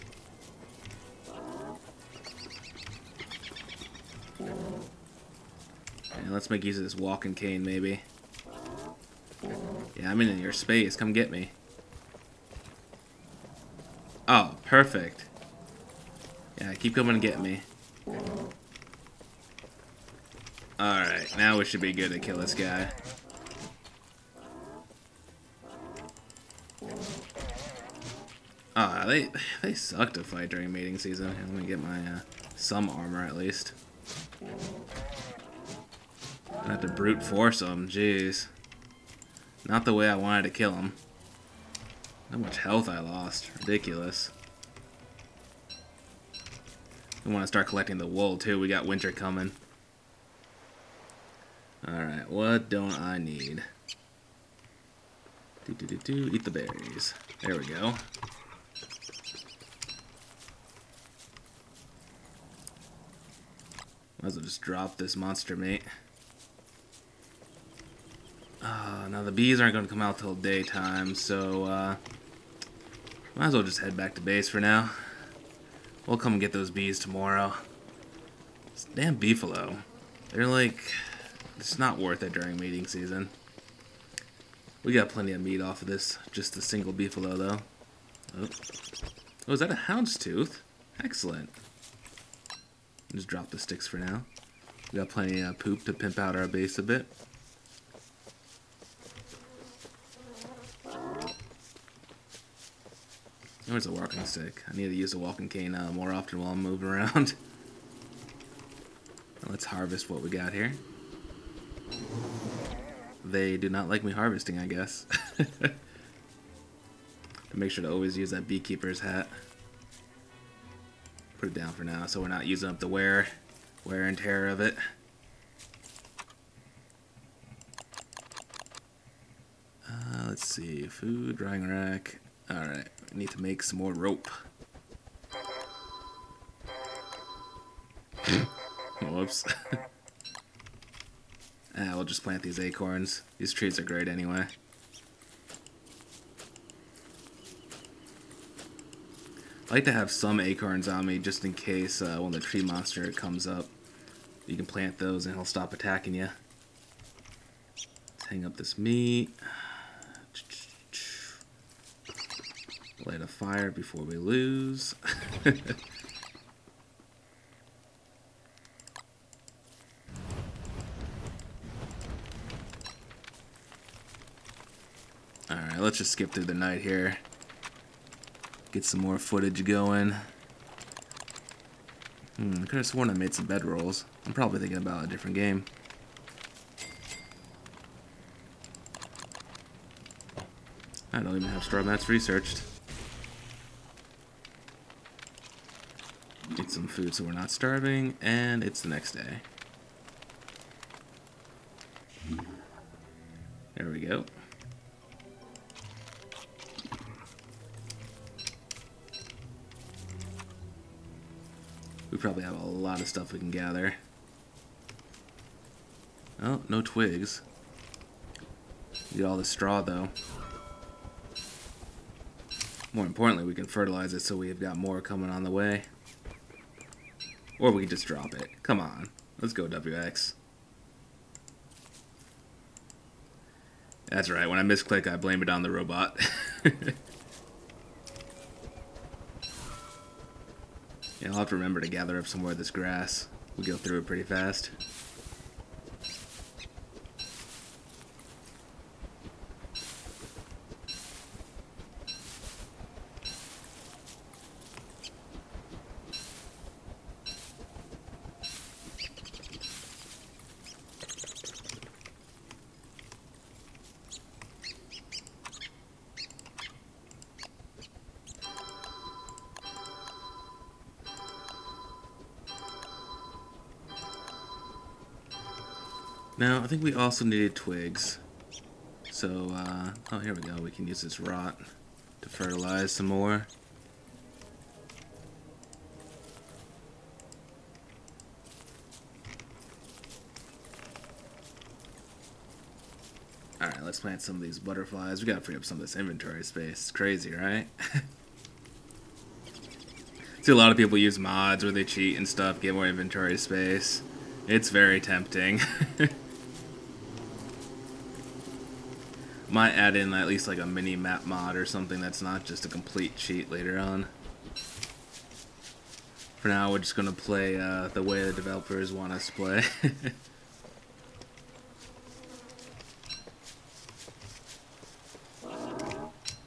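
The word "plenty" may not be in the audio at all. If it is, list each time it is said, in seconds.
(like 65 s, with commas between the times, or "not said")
85 s, 95 s.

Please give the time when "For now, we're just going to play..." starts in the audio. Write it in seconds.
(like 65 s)
316 s.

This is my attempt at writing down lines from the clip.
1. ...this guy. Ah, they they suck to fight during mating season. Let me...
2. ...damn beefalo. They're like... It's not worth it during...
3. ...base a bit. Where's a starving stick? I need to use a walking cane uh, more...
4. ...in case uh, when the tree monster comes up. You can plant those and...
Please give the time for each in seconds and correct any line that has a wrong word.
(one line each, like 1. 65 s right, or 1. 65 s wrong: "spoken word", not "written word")
1. 22 s right
2. 78 s right
3. 96 s wrong: "walking", not "starving"
4. 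151 s right.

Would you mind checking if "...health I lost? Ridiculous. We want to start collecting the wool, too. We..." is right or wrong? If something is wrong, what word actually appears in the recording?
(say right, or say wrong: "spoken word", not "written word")
right.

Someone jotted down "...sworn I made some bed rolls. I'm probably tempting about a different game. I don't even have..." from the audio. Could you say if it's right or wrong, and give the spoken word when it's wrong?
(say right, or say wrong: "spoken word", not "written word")
wrong: "thinking", not "tempting".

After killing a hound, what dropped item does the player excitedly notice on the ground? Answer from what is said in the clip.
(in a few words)
Houndstooth.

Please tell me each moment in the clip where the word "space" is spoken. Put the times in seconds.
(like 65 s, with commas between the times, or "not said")
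10 s, 296 s, 303 s.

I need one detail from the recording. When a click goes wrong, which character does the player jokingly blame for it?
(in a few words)
WX.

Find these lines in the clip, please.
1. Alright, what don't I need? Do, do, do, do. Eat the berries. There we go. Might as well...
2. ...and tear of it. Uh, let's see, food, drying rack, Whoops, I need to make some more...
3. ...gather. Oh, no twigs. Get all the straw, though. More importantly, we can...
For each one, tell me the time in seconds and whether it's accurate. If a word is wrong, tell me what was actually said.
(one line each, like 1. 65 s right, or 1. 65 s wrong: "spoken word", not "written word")
1. 51 s right
2. 124 s wrong: "Alright", not "Whoops"
3. 213 s right.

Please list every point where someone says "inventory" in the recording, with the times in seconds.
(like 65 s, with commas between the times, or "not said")
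295 s, 302 s.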